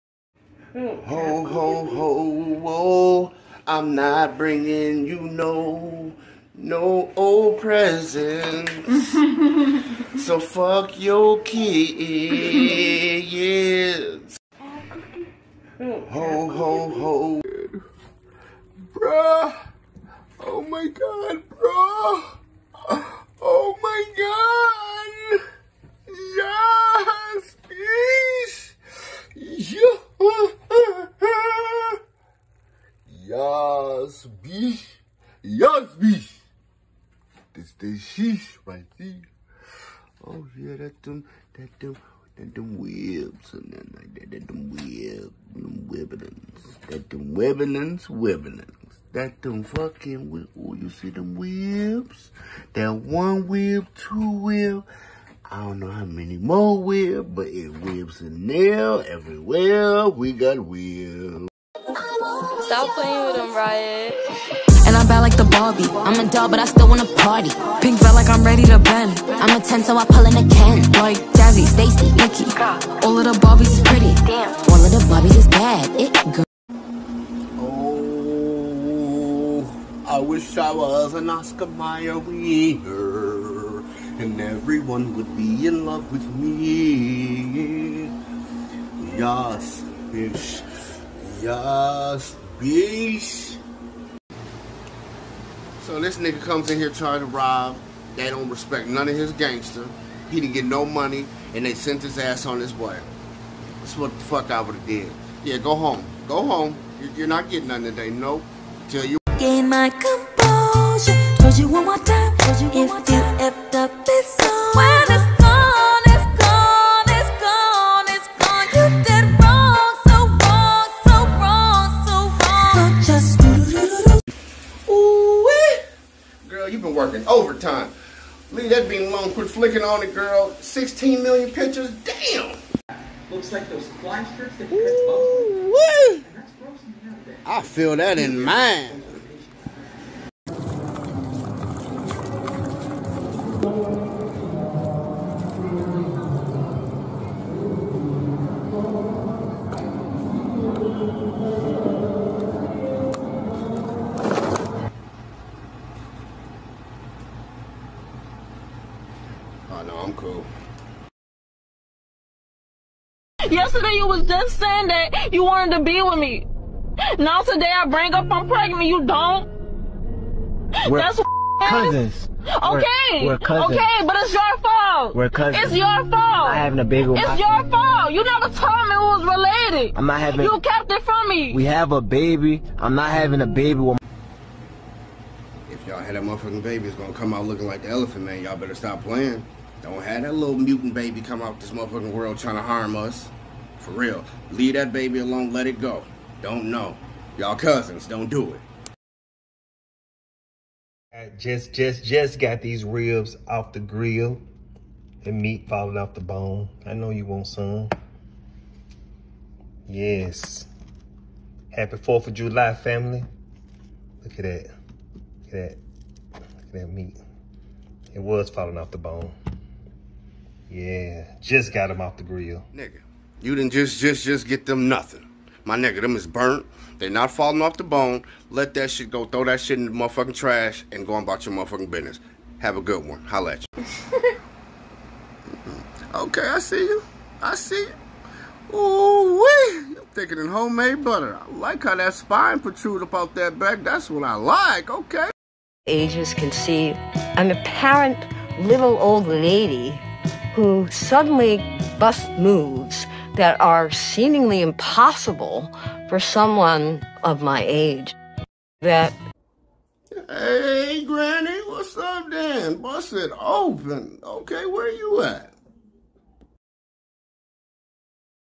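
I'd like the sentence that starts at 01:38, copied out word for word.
They don't respect none of his gangster.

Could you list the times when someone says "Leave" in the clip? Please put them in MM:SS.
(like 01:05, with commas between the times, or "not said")
02:08, 03:14.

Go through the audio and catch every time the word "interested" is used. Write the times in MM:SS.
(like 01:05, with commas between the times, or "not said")
not said.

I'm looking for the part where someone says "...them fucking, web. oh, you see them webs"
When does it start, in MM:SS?
00:49.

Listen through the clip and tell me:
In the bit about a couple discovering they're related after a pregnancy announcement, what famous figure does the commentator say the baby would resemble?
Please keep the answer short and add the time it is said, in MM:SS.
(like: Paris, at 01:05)
The Elephant Man, at 03:07.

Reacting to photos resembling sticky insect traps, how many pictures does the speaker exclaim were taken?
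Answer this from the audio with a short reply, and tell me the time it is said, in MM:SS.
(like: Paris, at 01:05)
16 million, at 02:10.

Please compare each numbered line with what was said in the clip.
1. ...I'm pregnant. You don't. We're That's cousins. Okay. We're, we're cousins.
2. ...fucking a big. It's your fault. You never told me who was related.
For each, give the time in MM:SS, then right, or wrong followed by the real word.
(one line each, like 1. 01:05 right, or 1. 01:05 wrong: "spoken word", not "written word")
1. 02:48 right
2. 02:56 wrong: "having", not "fucking".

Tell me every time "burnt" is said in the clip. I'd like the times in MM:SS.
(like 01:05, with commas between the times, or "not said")
03:46.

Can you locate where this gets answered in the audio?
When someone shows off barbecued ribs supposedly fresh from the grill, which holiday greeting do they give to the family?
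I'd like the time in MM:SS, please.
03:31.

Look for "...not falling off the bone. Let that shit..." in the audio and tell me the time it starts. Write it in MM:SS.
03:47.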